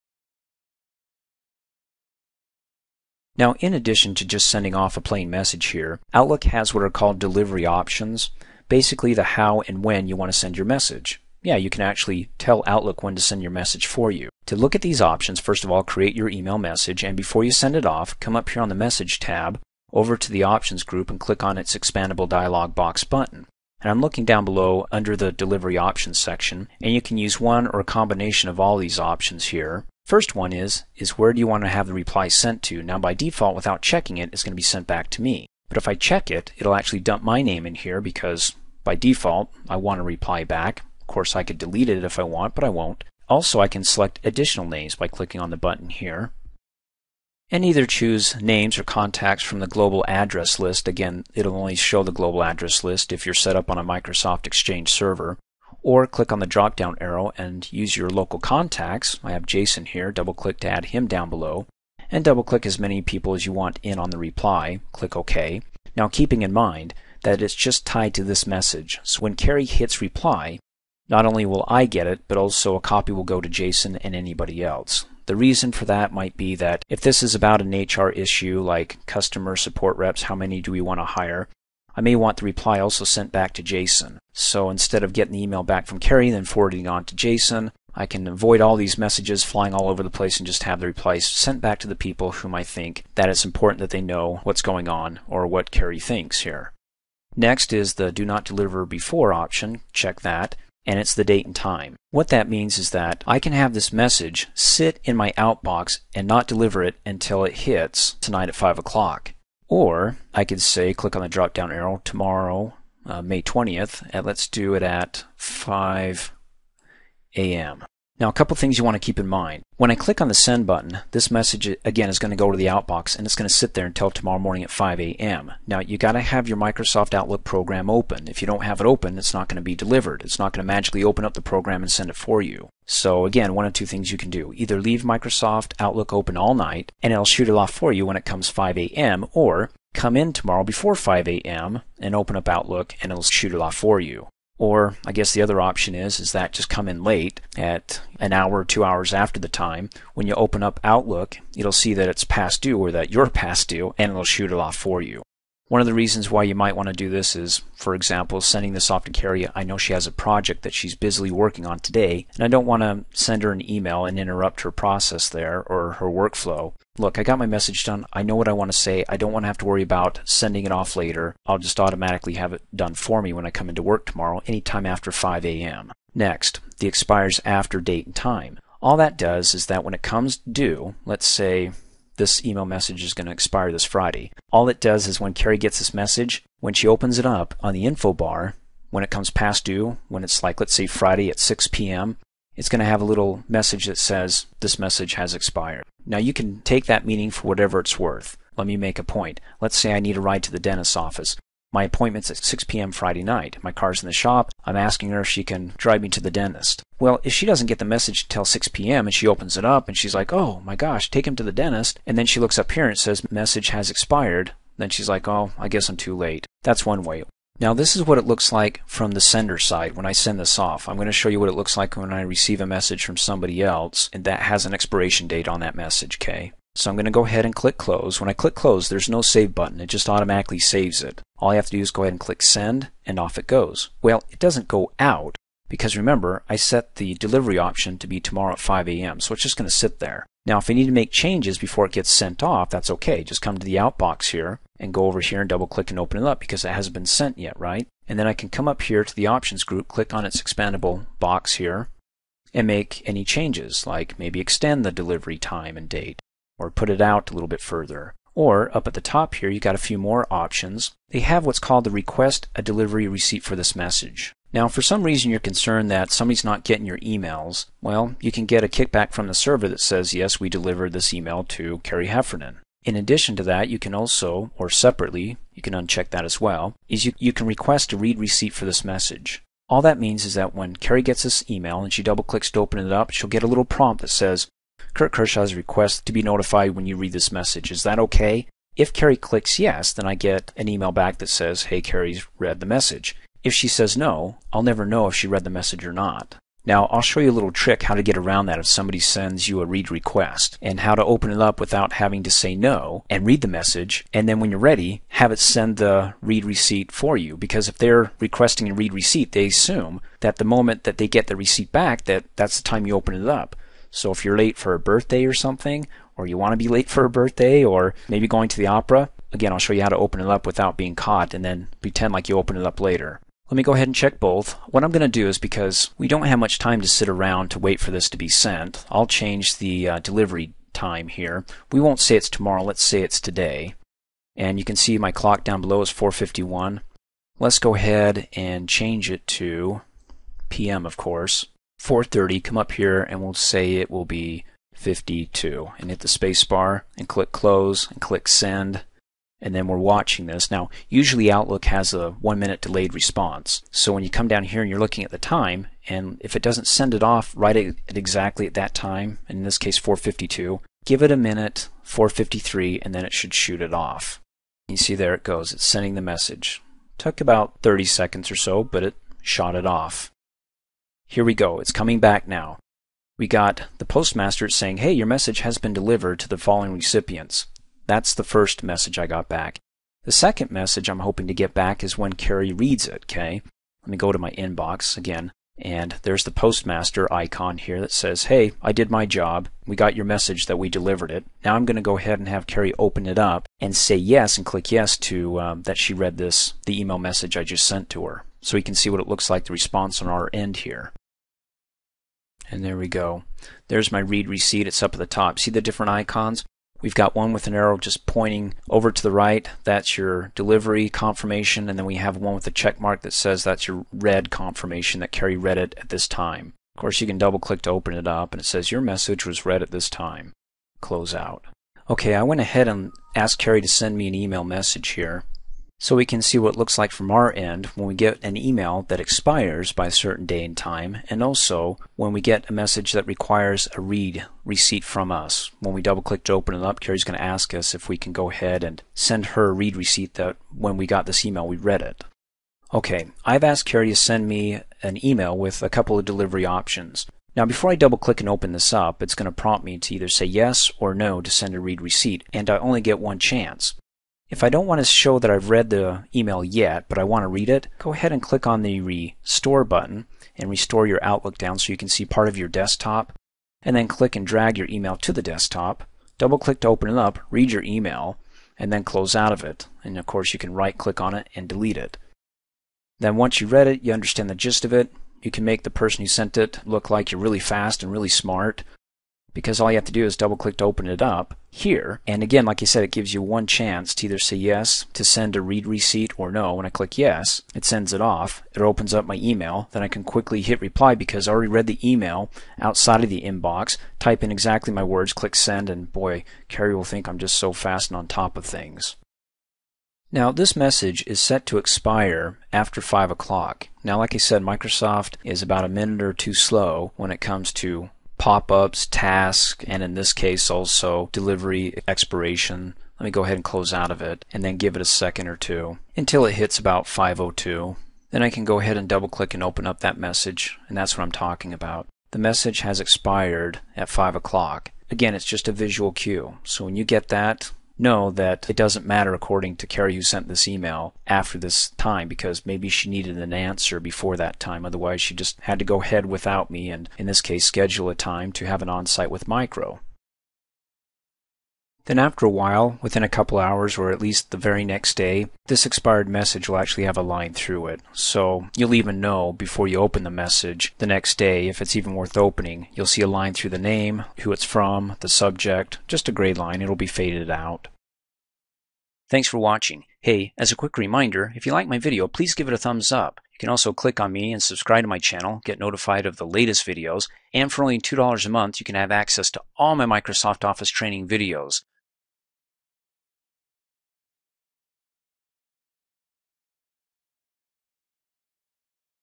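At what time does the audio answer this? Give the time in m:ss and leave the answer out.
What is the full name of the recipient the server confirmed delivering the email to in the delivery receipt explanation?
4:31.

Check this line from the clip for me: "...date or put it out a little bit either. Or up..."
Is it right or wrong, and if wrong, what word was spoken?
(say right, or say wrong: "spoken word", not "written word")
wrong: "further", not "either".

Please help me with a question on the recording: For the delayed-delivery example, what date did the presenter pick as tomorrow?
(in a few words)
May 20th.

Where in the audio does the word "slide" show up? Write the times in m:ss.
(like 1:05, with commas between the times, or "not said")
not said.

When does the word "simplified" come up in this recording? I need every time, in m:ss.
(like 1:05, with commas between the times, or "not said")
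not said.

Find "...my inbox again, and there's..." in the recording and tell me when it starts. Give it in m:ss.
6:24.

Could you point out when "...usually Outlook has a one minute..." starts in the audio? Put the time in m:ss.
5:50.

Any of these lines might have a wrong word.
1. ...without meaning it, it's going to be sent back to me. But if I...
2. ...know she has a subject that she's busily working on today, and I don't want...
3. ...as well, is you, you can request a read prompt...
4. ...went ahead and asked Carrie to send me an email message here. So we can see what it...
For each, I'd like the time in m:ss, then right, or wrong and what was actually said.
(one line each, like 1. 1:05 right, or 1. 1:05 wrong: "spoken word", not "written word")
1. 0:33 wrong: "checking", not "meaning"
2. 2:39 wrong: "project", not "subject"
3. 4:36 wrong: "receipt", not "prompt"
4. 7:02 right.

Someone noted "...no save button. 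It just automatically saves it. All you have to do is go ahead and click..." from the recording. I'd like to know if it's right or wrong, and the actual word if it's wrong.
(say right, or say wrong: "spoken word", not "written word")
right.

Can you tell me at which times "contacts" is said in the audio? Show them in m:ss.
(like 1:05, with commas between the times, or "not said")
0:48, 0:58.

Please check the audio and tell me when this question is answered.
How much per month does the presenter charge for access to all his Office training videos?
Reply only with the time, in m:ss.
9:27.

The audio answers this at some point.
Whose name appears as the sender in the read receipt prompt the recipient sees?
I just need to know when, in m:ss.
4:44.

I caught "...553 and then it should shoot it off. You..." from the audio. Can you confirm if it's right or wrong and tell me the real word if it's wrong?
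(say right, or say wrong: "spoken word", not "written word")
wrong: "453", not "553".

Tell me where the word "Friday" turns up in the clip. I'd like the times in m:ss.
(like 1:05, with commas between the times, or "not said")
3:03, 3:10, 3:22.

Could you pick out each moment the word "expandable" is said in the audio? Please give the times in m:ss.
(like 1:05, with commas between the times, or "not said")
0:21, 4:10.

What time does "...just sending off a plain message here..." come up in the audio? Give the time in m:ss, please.
0:04.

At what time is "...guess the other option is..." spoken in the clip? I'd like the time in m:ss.
2:25.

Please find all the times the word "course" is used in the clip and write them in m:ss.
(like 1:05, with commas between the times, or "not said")
0:41, 5:40, 6:56, 7:50.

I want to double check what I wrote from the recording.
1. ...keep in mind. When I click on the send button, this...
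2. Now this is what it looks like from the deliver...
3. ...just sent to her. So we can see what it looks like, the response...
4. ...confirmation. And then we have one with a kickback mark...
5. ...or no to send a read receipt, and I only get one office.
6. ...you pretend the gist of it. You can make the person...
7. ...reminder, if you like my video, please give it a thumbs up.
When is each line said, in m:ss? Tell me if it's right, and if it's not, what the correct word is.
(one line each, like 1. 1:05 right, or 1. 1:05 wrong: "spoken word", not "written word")
1. 1:58 right
2. 3:37 wrong: "sender", not "deliver"
3. 6:37 right
4. 6:50 wrong: "check", not "kickback"
5. 7:30 wrong: "chance", not "office"
6. 7:53 wrong: "understand", not "pretend"
7. 9:20 right.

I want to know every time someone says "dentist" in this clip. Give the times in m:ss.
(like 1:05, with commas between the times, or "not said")
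3:20, 3:26, 3:31.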